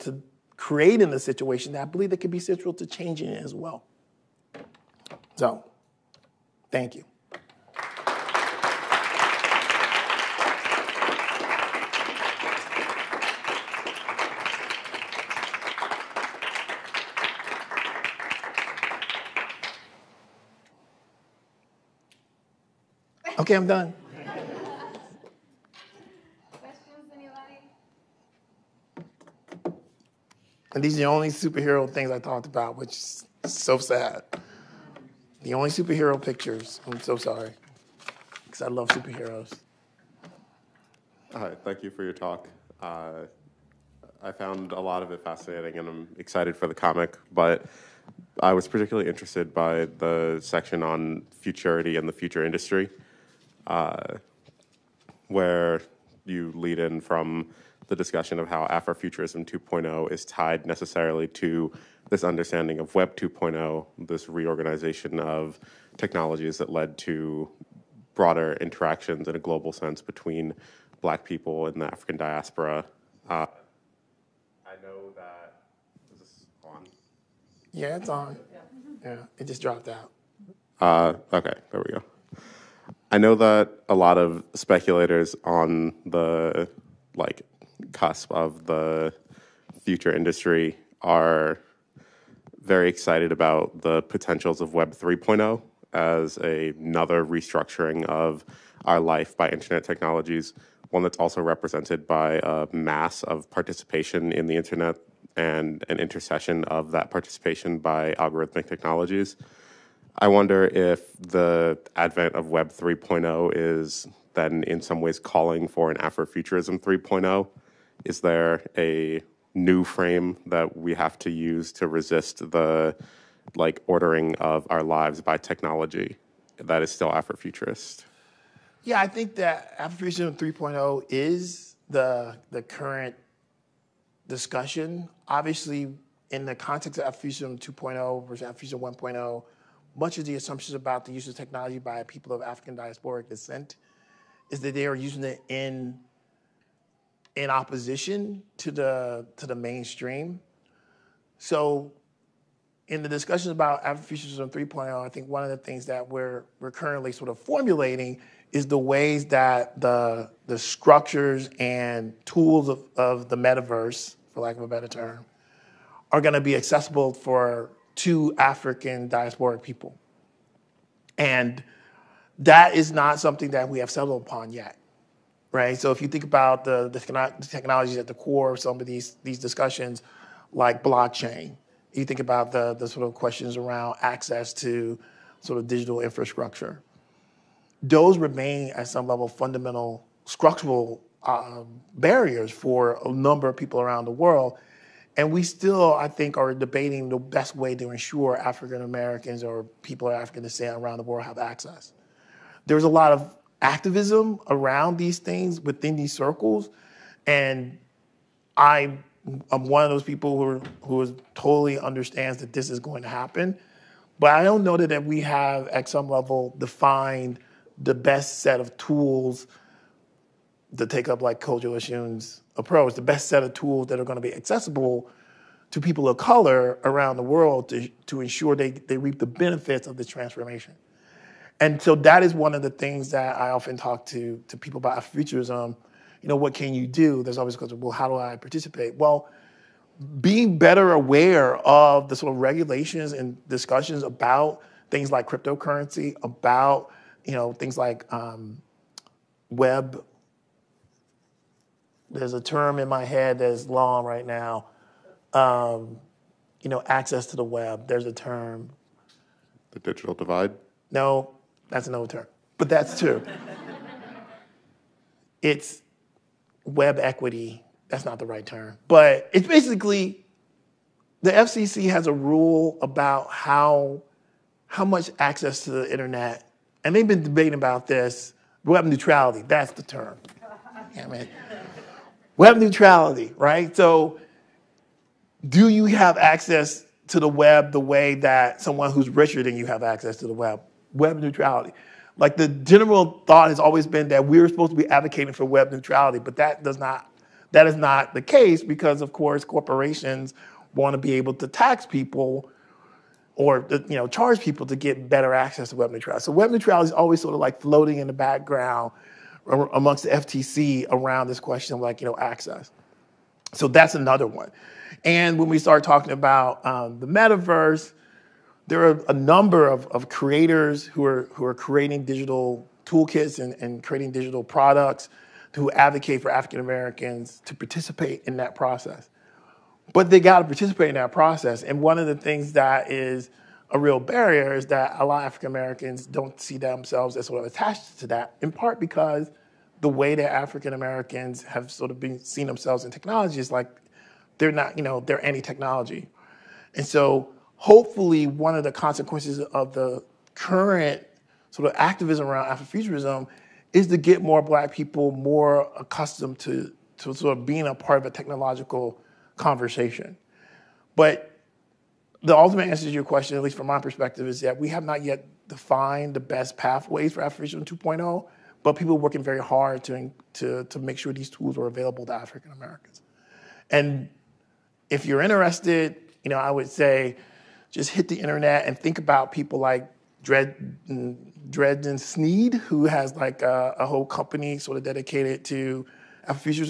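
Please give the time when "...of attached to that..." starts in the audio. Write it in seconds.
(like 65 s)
337 s.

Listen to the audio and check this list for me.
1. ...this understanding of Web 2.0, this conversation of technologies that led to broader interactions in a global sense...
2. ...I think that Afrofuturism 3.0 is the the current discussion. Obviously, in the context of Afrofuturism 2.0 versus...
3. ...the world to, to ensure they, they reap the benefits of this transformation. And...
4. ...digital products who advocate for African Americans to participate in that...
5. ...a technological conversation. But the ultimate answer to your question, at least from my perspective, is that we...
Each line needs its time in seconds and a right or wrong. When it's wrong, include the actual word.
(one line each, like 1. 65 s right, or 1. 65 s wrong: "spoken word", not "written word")
1. 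62 s wrong: "reorganization", not "conversation"
2. 129 s right
3. 227 s right
4. 324 s right
5. 358 s right.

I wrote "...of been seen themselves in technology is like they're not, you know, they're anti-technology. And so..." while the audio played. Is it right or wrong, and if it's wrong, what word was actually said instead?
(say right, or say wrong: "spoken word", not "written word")
right.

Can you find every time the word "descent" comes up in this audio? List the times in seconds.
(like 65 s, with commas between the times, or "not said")
143 s, 200 s.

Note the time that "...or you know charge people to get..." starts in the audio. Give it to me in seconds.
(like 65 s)
303 s.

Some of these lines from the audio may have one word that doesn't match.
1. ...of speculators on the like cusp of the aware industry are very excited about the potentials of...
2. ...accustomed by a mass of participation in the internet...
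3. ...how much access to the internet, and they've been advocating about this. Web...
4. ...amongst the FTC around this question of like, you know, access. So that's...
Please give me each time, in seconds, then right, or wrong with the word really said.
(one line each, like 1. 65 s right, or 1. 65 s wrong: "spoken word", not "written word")
1. 84 s wrong: "future", not "aware"
2. 101 s wrong: "represented", not "accustomed"
3. 274 s wrong: "debating", not "advocating"
4. 309 s right.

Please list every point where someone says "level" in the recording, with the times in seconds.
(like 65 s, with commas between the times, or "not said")
189 s, 216 s.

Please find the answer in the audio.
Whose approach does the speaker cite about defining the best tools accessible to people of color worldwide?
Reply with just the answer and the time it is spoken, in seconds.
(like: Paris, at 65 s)
Kodwo Eshun, at 221 s.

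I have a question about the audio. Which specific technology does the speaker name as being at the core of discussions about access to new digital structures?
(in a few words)
blockchain.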